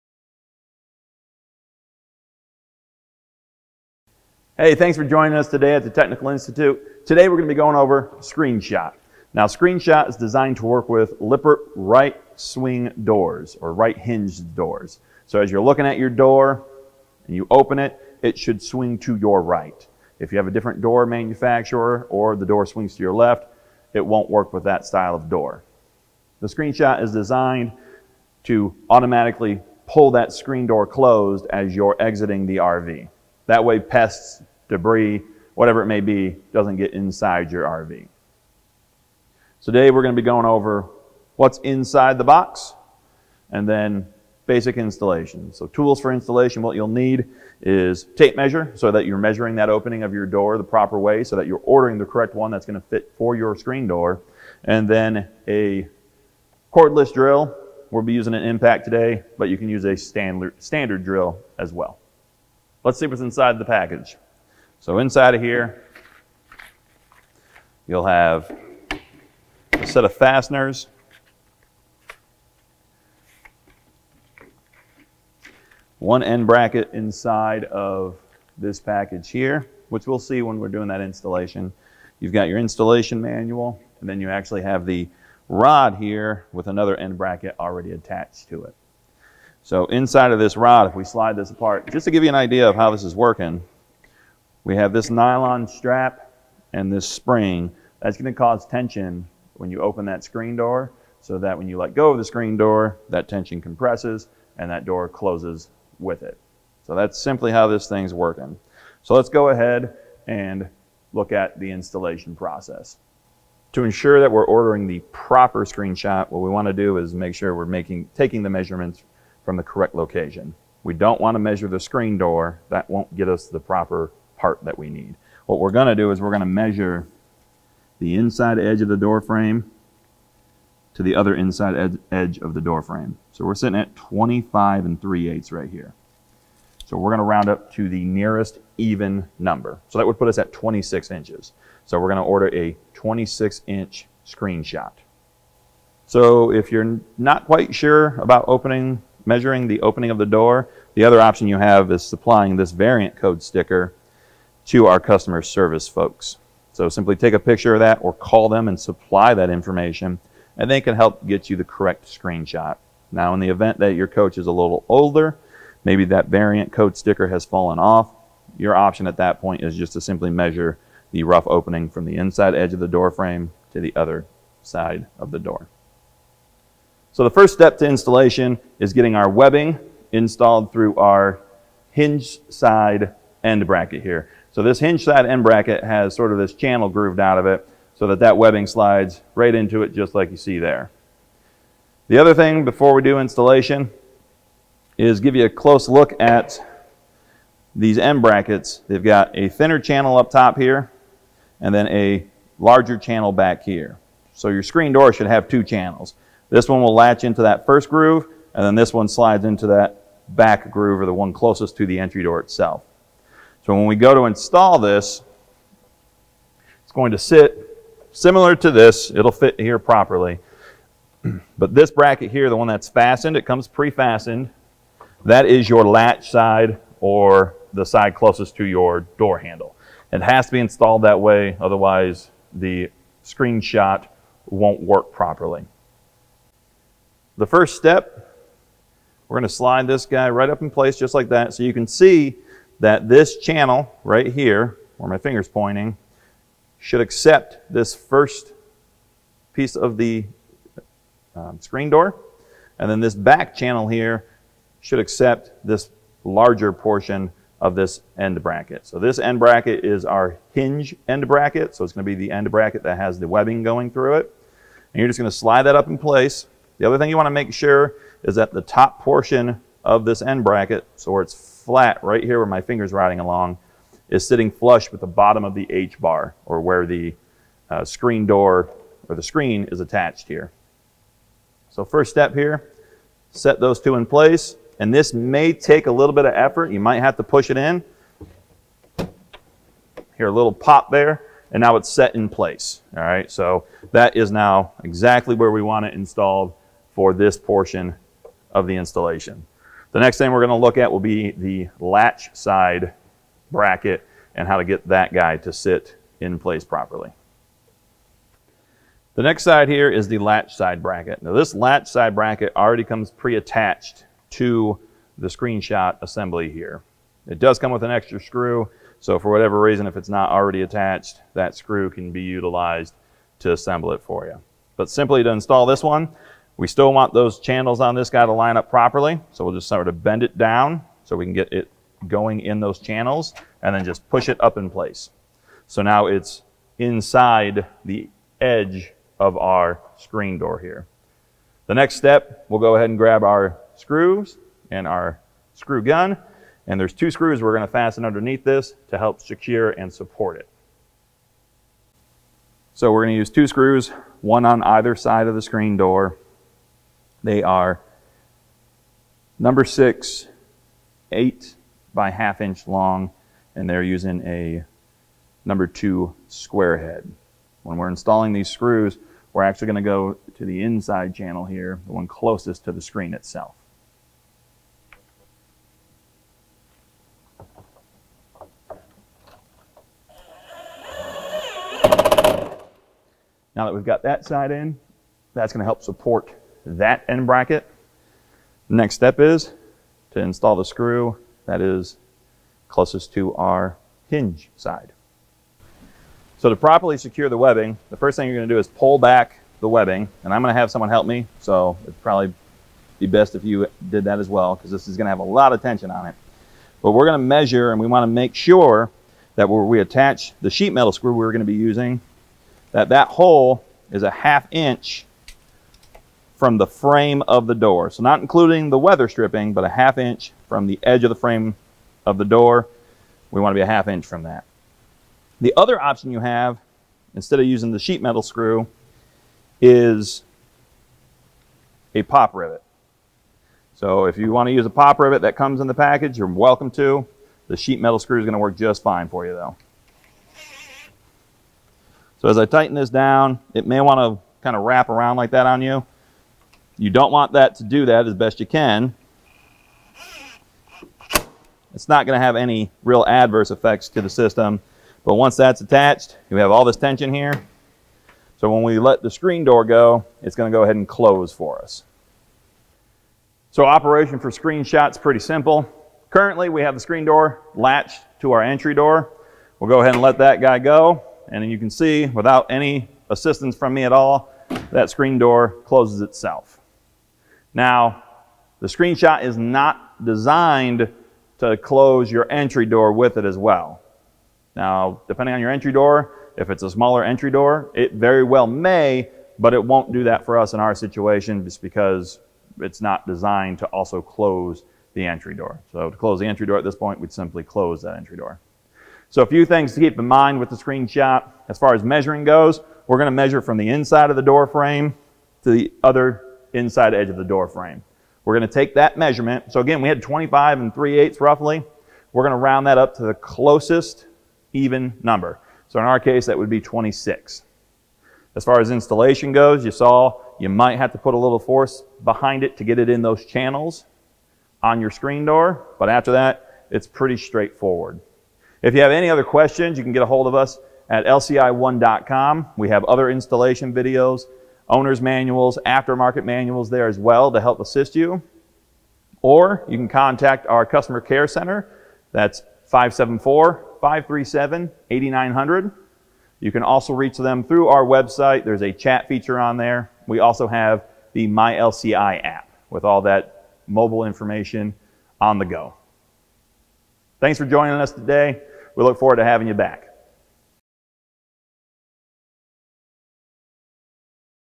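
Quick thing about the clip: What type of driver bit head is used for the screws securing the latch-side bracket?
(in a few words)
number 2 square head.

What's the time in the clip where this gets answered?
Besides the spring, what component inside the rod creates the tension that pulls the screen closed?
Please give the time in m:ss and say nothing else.
1:35.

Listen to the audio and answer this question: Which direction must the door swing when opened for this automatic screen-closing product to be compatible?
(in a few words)
to your right.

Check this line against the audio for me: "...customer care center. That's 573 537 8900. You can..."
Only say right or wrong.
wrong.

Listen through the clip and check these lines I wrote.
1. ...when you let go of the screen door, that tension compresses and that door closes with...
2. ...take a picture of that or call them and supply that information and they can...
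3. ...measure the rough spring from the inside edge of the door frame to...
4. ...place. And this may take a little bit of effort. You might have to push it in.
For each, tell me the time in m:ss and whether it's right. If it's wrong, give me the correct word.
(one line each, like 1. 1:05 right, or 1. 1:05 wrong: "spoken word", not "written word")
1. 1:41 right
2. 2:37 right
3. 2:50 wrong: "opening", not "spring"
4. 4:44 right.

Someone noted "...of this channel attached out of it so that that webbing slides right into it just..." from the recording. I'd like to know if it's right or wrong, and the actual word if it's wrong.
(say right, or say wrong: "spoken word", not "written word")
wrong: "grooved", not "attached".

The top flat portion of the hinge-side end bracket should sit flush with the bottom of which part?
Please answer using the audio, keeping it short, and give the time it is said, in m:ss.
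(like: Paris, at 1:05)
H bar, at 4:35.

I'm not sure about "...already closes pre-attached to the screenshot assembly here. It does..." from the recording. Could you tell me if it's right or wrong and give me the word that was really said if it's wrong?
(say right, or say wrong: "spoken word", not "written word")
wrong: "comes", not "closes".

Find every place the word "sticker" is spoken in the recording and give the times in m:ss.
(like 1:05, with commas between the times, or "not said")
2:33, 2:46.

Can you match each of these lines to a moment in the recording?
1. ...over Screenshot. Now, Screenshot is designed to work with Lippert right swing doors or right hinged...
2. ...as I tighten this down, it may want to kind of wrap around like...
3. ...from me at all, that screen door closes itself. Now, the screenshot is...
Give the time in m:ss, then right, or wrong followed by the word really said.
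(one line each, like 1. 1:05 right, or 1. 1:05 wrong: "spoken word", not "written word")
1. 0:07 right
2. 7:22 right
3. 7:53 right.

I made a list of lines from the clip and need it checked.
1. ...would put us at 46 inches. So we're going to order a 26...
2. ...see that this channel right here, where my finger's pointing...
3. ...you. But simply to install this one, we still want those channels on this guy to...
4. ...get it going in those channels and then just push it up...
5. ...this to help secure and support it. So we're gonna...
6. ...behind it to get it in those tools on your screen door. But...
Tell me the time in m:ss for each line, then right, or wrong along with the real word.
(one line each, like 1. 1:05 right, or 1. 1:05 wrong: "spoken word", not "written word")
1. 2:20 wrong: "26", not "46"
2. 4:01 right
3. 5:24 right
4. 5:31 right
5. 5:48 right
6. 8:42 wrong: "channels", not "tools".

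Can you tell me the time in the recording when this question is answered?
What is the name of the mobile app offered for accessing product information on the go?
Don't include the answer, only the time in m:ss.
9:11.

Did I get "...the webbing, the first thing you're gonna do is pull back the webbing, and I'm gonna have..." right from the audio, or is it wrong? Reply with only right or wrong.
right.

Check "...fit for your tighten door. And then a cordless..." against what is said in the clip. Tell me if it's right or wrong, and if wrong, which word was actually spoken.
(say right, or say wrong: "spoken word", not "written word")
wrong: "screen", not "tighten".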